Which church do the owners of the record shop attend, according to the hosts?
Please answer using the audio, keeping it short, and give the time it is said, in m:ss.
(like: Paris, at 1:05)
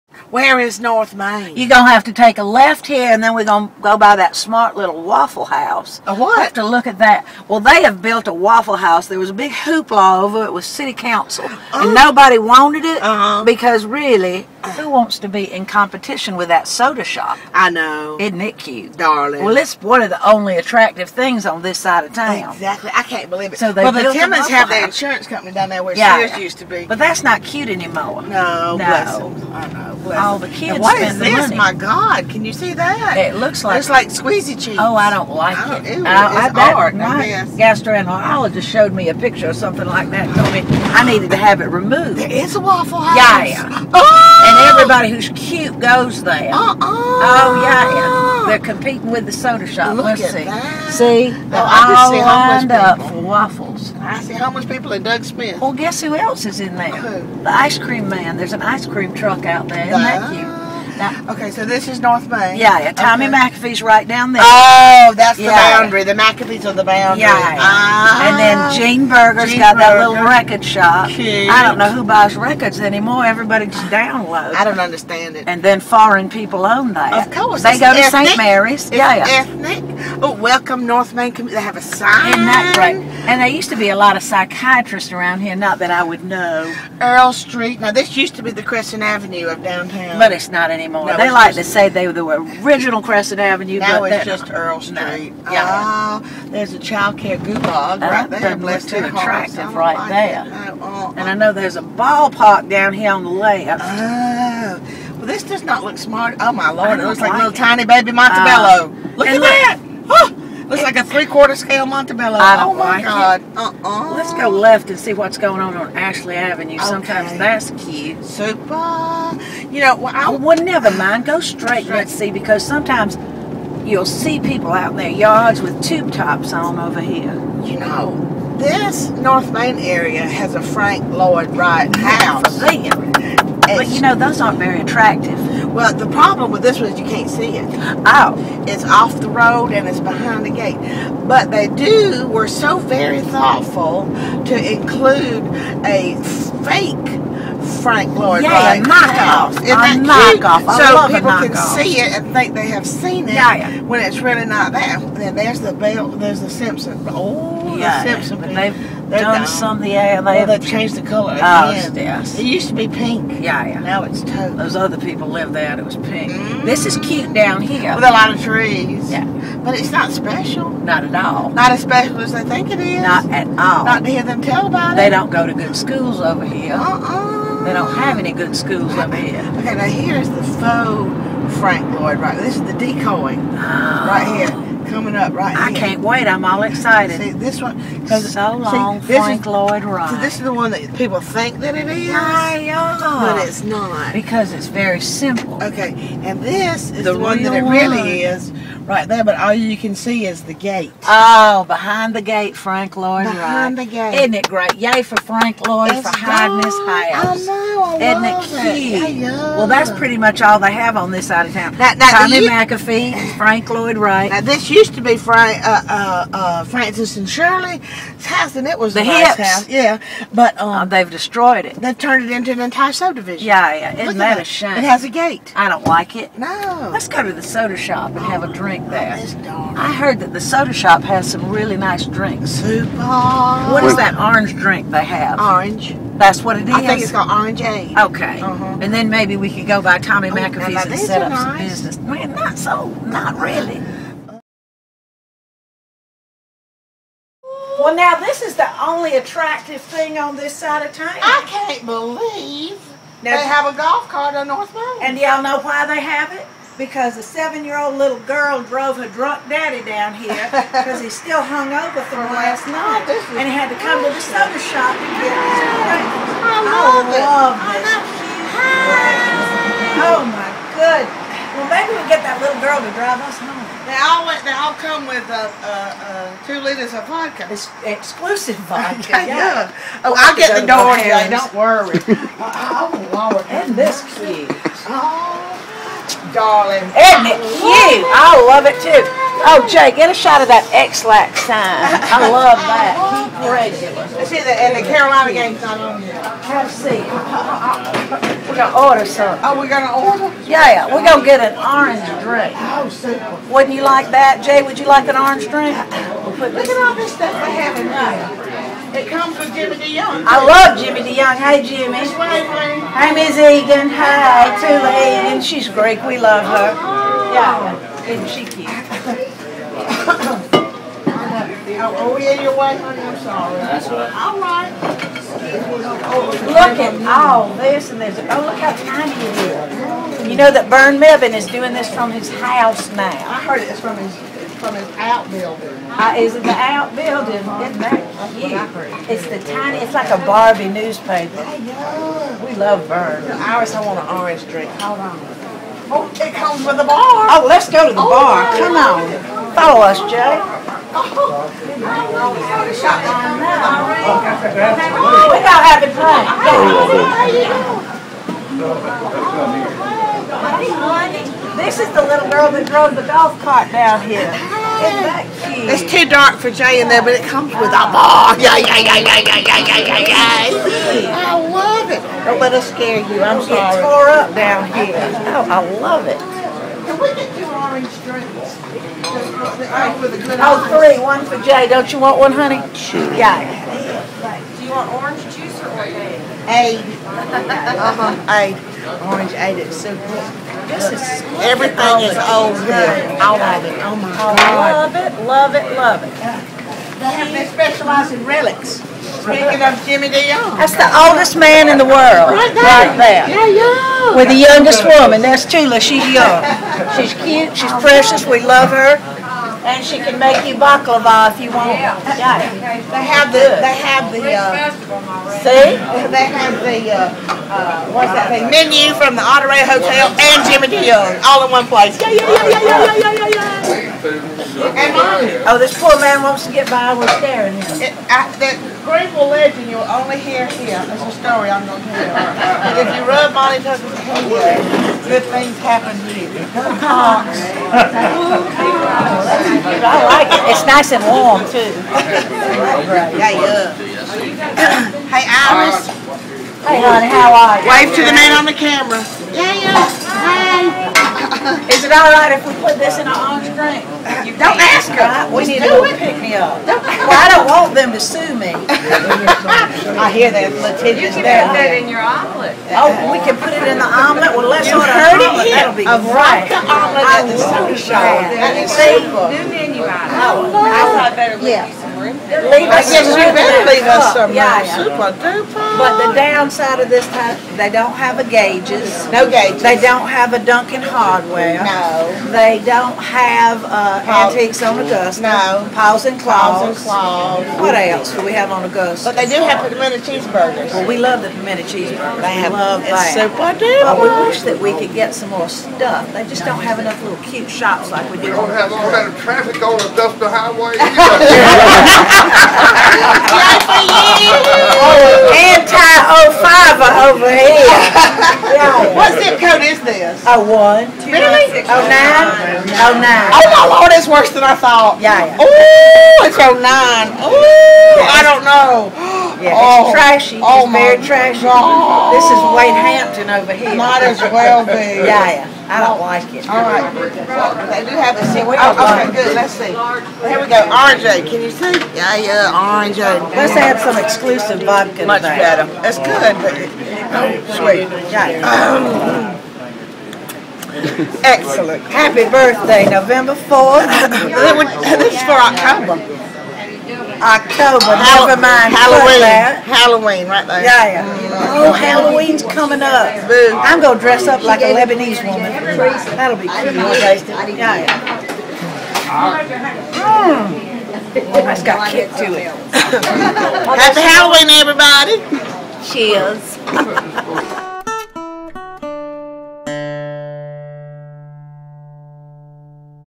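St. Mary's, at 1:18.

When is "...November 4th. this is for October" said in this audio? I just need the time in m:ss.
9:02.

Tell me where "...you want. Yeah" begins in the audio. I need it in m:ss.
6:51.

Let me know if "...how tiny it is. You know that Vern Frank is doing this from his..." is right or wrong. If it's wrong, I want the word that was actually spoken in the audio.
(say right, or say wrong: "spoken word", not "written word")
wrong: "Mevin", not "Frank".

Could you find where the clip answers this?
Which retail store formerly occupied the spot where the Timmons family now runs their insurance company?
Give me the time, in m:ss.
0:26.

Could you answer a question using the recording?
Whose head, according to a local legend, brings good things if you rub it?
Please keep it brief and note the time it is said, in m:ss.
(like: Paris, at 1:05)
Monty Tucker, at 7:13.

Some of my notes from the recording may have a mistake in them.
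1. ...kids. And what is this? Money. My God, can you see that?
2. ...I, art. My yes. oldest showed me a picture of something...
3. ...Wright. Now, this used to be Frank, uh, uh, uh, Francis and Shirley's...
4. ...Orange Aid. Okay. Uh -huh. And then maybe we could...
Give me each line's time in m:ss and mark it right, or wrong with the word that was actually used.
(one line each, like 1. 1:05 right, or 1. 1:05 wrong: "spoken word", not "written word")
1. 0:30 right
2. 0:36 wrong: "gastroenterologist", not "oldest"
3. 3:33 right
4. 3:57 right.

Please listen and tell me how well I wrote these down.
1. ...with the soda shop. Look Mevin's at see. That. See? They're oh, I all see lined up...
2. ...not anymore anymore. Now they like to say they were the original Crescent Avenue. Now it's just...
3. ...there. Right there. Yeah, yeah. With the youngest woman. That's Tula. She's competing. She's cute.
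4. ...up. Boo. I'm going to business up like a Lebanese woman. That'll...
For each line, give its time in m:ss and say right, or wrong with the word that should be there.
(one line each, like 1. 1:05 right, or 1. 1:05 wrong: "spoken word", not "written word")
1. 0:49 wrong: "Let", not "Mevin"
2. 1:30 right
3. 6:42 wrong: "young", not "competing"
4. 9:12 wrong: "dress", not "business".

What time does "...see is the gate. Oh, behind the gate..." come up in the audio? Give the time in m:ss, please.
3:19.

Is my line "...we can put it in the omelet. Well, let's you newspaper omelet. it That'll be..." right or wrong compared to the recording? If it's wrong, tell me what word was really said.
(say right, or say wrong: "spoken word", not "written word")
wrong: "order", not "newspaper".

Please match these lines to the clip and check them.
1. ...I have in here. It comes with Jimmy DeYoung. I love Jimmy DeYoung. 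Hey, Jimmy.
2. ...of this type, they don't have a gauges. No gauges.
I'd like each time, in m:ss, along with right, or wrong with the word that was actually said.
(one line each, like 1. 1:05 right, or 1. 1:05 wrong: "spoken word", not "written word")
1. 5:07 right
2. 7:56 right.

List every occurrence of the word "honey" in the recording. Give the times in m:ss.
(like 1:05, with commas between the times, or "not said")
5:22, 6:22, 7:26.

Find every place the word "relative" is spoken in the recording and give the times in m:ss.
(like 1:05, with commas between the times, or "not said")
not said.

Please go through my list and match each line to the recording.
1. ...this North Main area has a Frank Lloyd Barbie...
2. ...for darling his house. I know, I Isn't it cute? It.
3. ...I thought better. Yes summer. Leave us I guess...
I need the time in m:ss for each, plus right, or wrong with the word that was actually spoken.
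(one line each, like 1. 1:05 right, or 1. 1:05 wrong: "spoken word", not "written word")
1. 2:08 wrong: "Wright", not "Barbie"
2. 3:26 wrong: "hiding", not "darling"
3. 7:50 right.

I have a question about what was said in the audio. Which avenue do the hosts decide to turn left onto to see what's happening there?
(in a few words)
Ashley Avenue.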